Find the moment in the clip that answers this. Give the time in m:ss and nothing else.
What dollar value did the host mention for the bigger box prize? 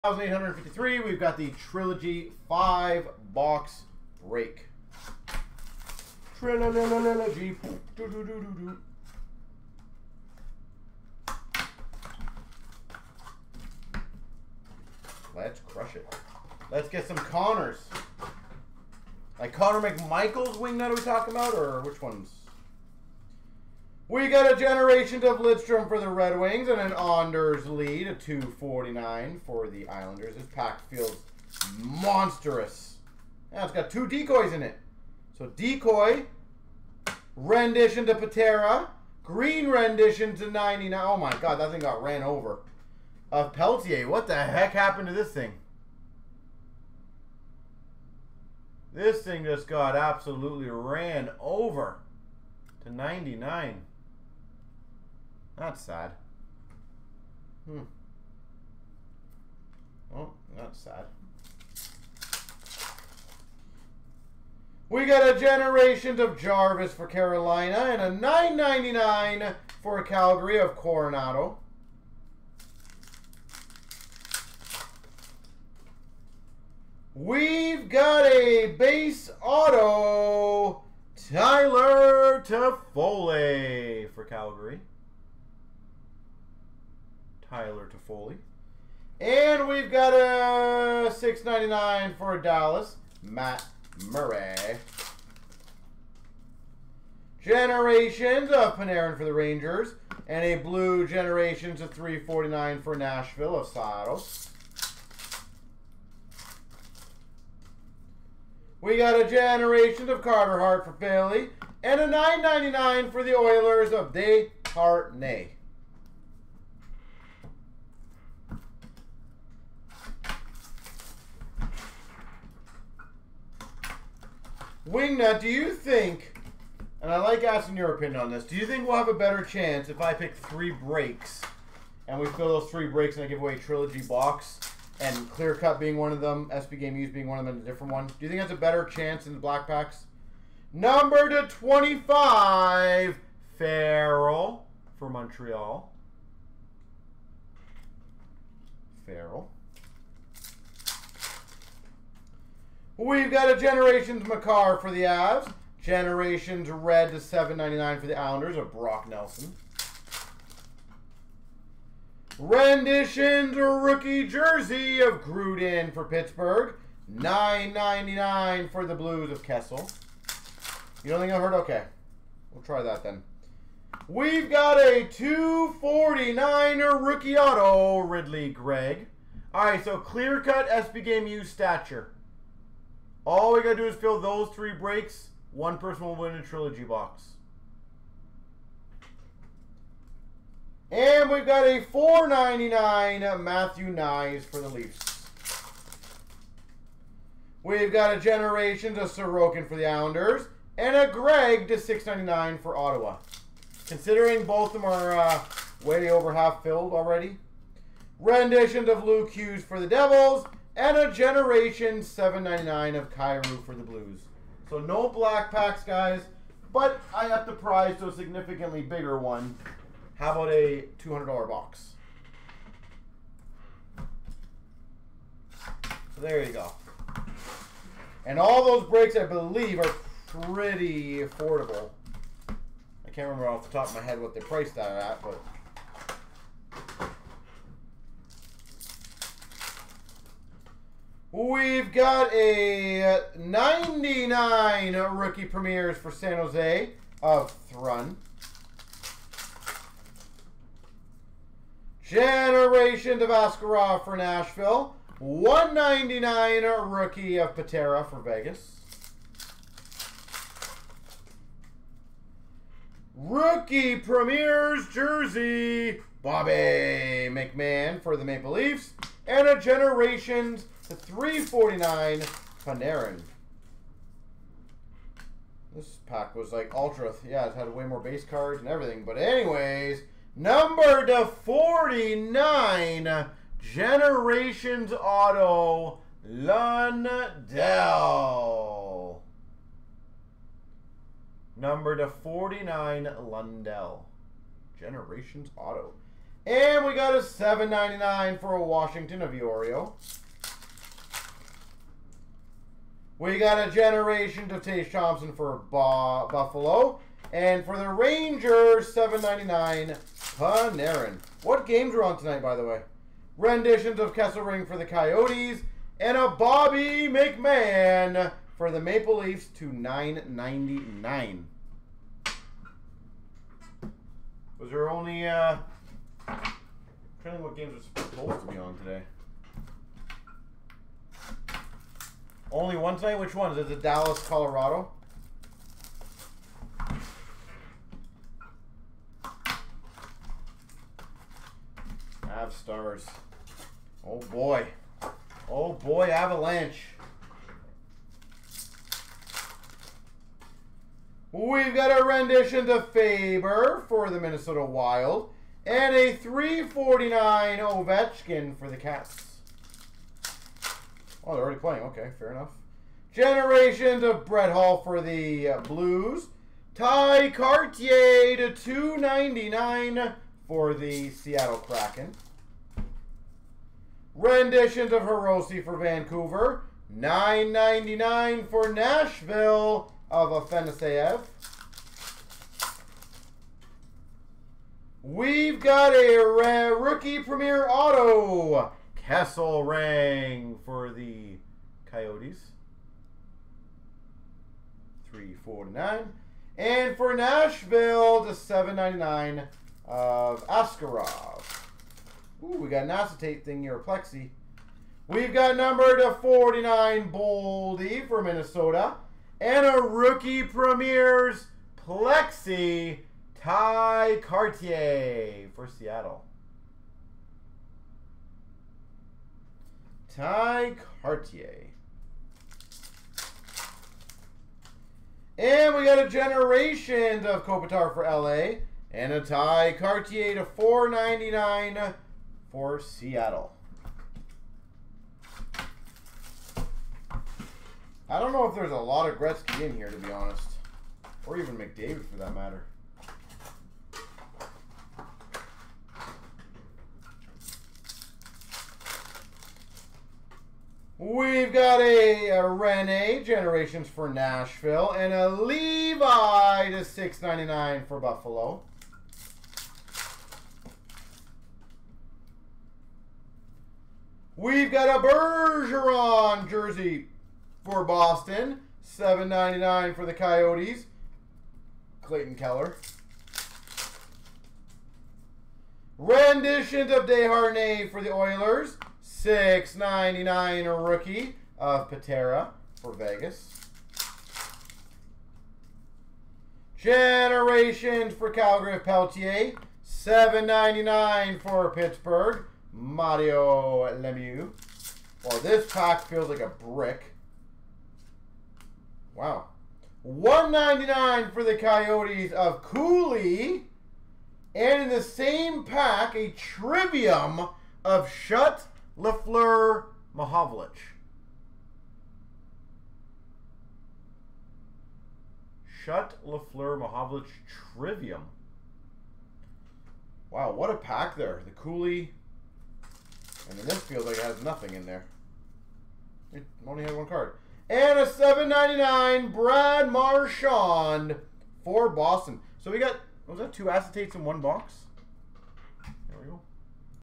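3:40.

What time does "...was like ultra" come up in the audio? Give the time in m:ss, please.
4:36.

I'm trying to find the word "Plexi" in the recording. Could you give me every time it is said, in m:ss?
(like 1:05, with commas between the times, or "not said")
6:43, 6:51.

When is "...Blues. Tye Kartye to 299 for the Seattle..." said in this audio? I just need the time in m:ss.
6:05.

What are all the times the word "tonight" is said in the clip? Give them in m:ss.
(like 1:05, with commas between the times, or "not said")
5:12, 5:32.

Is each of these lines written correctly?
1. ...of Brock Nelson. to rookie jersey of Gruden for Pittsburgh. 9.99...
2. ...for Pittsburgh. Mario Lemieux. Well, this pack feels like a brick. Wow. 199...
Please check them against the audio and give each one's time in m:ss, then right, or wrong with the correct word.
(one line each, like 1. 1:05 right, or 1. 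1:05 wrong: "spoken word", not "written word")
1. 2:38 right
2. 8:11 right.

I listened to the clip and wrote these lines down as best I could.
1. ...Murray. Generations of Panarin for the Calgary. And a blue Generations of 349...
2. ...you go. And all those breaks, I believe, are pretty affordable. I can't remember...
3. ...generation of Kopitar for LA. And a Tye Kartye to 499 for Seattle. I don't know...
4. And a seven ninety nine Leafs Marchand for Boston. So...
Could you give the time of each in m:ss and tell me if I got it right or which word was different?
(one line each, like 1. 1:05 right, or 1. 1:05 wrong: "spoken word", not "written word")
1. 1:34 wrong: "Rangers", not "Calgary"
2. 3:46 right
3. 7:06 right
4. 8:47 wrong: "Brad", not "Leafs".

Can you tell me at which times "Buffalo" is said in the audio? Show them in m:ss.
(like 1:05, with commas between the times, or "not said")
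5:06, 7:37.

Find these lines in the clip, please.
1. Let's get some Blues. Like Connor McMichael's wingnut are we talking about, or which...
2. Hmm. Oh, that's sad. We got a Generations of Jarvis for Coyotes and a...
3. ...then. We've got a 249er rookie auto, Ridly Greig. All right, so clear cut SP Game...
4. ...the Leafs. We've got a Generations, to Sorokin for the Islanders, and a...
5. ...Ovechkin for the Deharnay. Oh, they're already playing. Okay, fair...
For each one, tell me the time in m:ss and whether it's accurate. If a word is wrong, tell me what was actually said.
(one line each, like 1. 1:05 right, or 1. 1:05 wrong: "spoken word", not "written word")
1. 0:16 wrong: "Connors", not "Blues"
2. 0:57 wrong: "Carolina", not "Coyotes"
3. 2:53 right
4. 3:14 right
5. 5:57 wrong: "Cats", not "Deharnay".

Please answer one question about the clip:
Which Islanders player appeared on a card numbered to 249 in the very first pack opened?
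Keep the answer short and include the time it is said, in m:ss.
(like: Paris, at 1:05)
Anders Lee, at 0:26.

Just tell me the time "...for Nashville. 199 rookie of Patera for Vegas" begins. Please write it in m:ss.
4:14.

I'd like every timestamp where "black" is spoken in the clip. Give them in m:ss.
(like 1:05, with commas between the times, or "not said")
2:19, 3:35.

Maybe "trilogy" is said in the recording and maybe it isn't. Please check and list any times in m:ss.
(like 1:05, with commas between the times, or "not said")
0:01, 0:06, 2:13, 3:06.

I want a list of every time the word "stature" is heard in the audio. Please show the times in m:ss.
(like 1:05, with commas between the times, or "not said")
3:01.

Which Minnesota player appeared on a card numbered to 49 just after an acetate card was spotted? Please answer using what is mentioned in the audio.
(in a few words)
Boldy.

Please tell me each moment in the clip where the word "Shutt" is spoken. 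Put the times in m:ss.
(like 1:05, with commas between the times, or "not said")
8:28, 8:35.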